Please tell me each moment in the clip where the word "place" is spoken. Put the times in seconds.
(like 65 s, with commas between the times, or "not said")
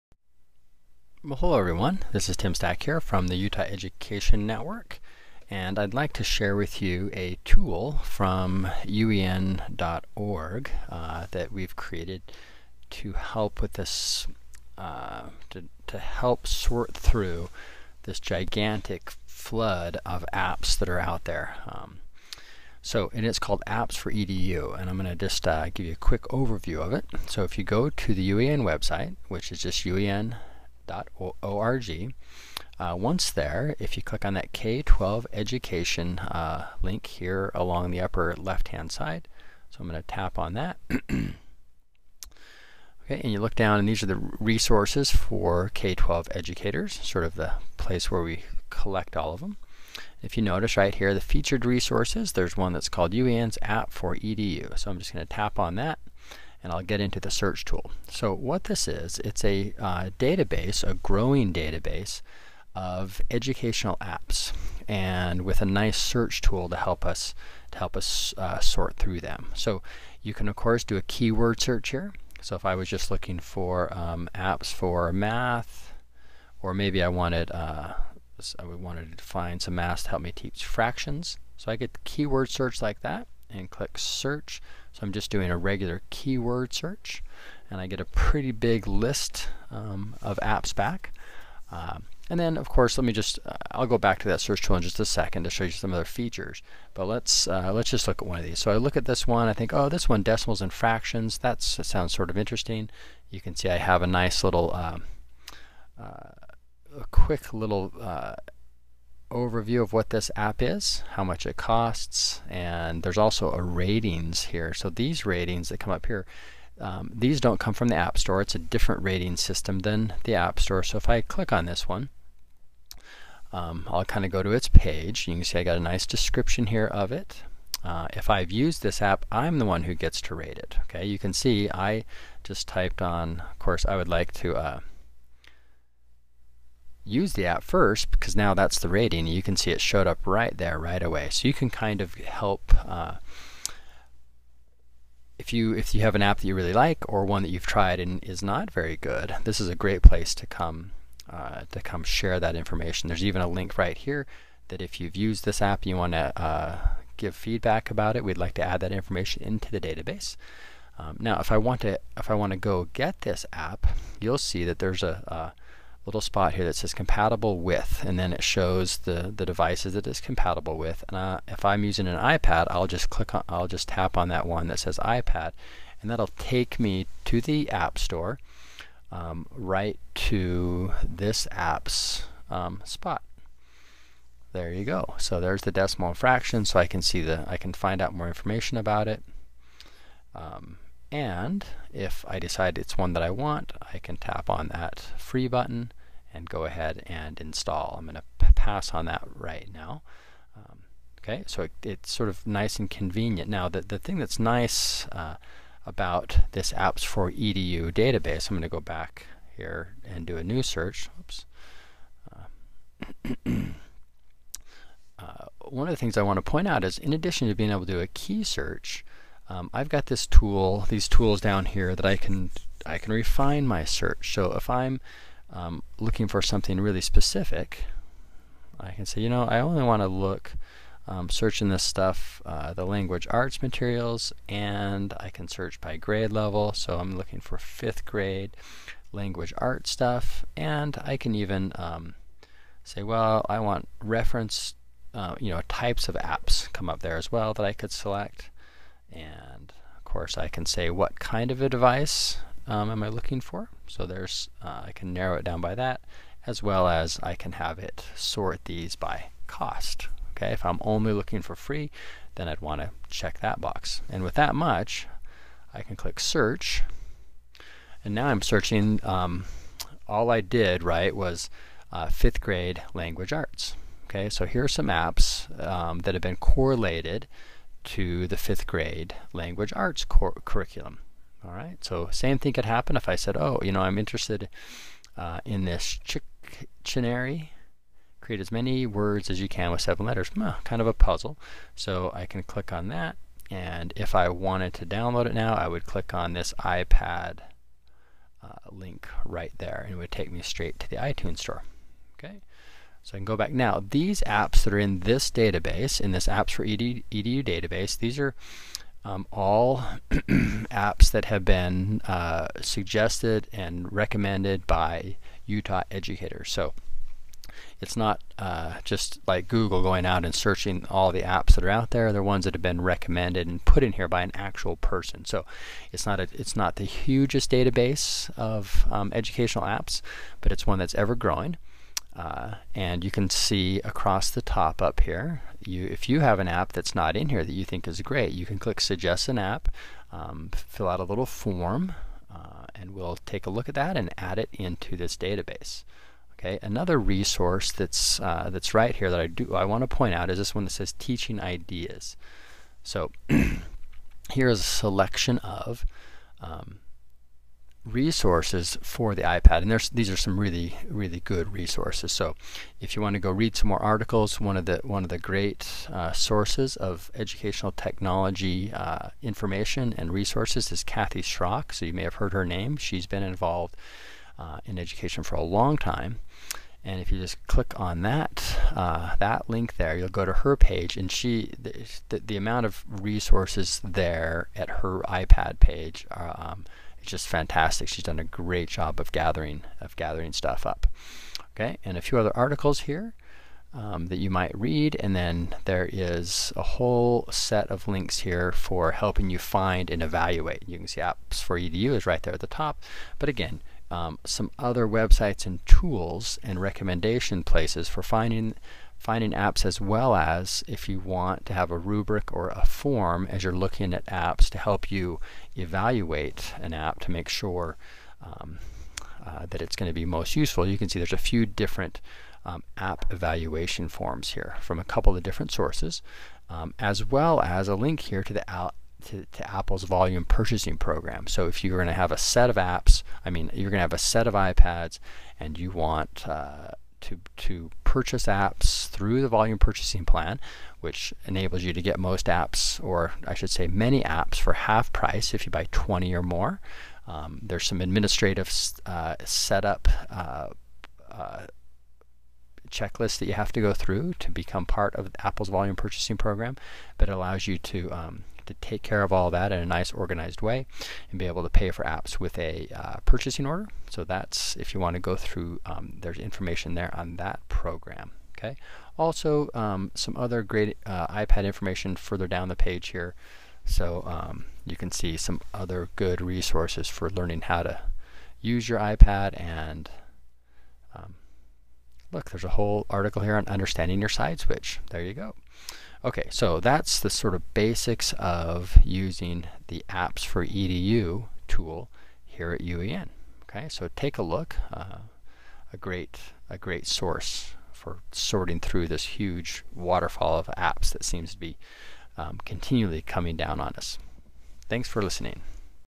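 47 s, 150 s, 407 s.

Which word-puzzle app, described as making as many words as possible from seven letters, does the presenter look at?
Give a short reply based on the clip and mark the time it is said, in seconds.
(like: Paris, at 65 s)
Chicktionary, at 286 s.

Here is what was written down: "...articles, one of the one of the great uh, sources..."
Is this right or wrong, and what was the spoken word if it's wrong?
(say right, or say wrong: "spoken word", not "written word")
right.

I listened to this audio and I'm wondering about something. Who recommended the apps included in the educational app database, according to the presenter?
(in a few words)
Utah educators.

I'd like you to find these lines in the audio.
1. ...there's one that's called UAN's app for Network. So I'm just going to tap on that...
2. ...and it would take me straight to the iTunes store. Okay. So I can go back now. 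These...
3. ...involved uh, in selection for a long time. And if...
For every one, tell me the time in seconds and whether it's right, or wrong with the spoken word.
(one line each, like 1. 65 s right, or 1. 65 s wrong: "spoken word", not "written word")
1. 52 s wrong: "EDU", not "Network"
2. 299 s right
3. 373 s wrong: "education", not "selection".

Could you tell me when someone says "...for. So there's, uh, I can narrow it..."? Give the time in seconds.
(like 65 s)
253 s.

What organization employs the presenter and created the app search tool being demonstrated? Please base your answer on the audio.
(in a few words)
Utah Education Network.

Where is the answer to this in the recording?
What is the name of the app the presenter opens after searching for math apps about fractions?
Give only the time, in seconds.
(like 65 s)
100 s.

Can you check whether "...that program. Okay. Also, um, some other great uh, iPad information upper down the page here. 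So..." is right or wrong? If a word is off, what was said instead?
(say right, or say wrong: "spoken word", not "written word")
wrong: "further", not "upper".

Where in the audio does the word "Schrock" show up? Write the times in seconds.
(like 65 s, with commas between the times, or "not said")
371 s.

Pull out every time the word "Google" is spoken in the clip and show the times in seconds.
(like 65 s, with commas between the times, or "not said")
319 s.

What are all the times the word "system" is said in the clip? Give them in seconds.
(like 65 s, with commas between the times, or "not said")
119 s.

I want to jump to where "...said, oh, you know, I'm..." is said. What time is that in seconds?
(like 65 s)
283 s.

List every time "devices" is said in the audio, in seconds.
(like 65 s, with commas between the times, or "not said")
169 s, 251 s.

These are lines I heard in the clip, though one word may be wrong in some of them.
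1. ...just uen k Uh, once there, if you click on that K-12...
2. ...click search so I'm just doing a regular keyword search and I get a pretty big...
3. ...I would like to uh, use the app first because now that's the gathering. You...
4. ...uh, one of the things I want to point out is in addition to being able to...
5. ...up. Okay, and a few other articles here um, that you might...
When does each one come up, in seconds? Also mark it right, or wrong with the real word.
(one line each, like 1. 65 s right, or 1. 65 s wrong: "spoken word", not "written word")
1. 29 s right
2. 83 s right
3. 133 s wrong: "rating", not "gathering"
4. 215 s right
5. 390 s right.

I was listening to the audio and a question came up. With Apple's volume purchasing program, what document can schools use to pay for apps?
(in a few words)
Purchasing order.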